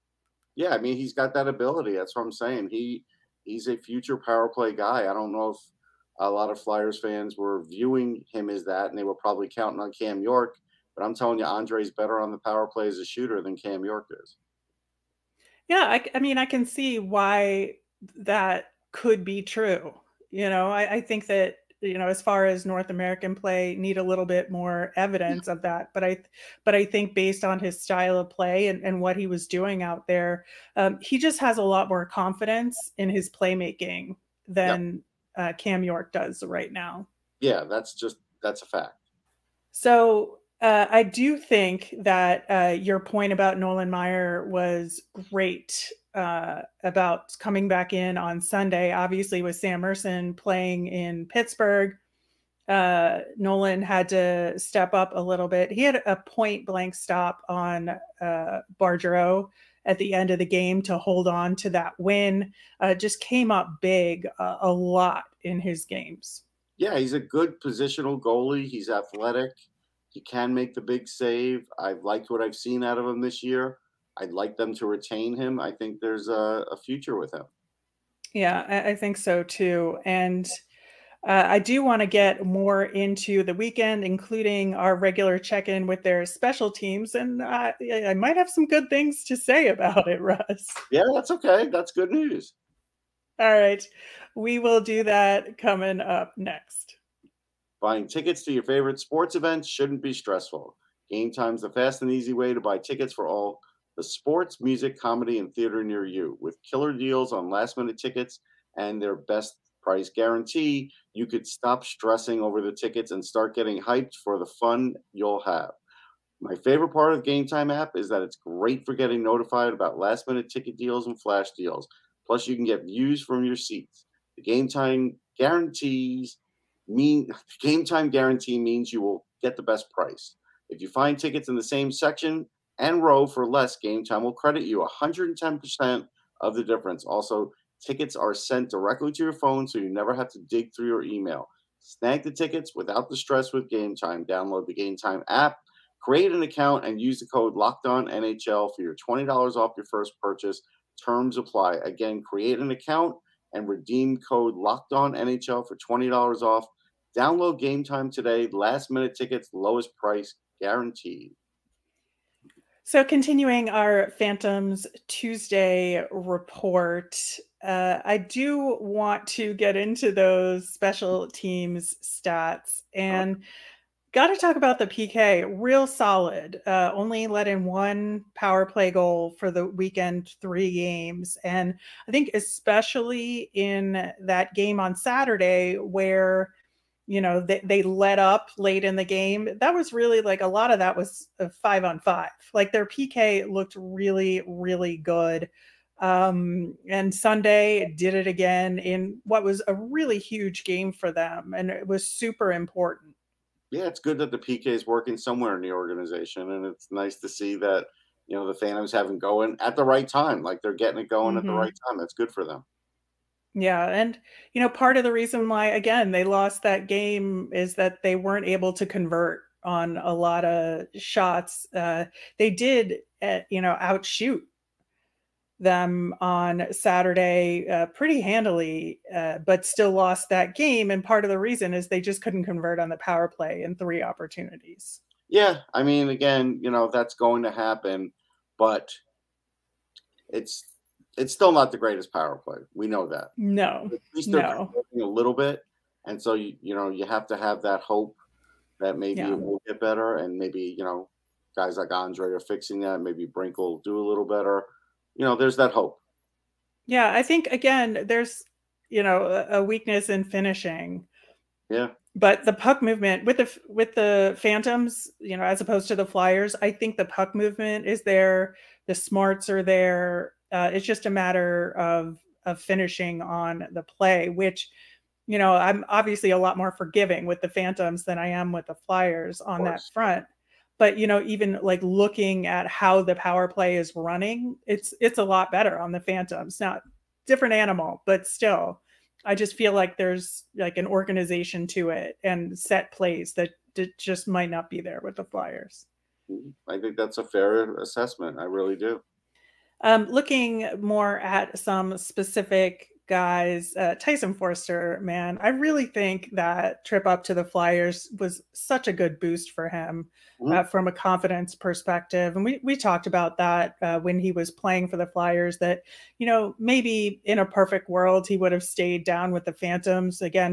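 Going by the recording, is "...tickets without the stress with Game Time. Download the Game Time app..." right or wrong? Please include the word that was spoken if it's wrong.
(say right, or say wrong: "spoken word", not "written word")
right.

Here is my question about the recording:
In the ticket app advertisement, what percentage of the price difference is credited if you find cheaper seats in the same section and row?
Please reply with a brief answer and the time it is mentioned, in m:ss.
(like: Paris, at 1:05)
110%, at 2:15.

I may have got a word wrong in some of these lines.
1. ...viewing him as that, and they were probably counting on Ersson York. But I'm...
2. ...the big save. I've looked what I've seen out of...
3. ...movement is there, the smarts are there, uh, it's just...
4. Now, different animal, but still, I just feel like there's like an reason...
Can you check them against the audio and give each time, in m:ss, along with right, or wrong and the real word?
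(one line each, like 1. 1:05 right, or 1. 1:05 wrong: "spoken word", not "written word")
1. 0:07 wrong: "Cam", not "Ersson"
2. 1:10 wrong: "liked", not "looked"
3. 4:27 right
4. 4:46 wrong: "organization", not "reason".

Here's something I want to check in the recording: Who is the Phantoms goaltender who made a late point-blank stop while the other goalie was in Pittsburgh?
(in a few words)
Nolan Maier.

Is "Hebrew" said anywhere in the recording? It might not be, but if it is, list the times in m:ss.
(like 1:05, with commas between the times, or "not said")
not said.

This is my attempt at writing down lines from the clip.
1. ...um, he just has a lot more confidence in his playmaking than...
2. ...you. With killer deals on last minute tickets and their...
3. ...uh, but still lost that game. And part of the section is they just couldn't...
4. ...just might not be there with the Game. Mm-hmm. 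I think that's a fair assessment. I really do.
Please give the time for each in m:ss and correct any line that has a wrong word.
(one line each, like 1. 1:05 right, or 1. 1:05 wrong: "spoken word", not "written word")
1. 0:30 right
2. 1:46 right
3. 3:49 wrong: "reason", not "section"
4. 4:53 wrong: "Flyers", not "Game".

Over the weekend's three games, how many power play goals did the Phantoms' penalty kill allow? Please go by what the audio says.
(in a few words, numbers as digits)
1.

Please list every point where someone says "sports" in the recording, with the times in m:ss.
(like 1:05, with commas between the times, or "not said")
1:39, 1:44.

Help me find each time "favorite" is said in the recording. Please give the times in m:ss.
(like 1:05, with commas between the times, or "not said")
1:38, 1:56.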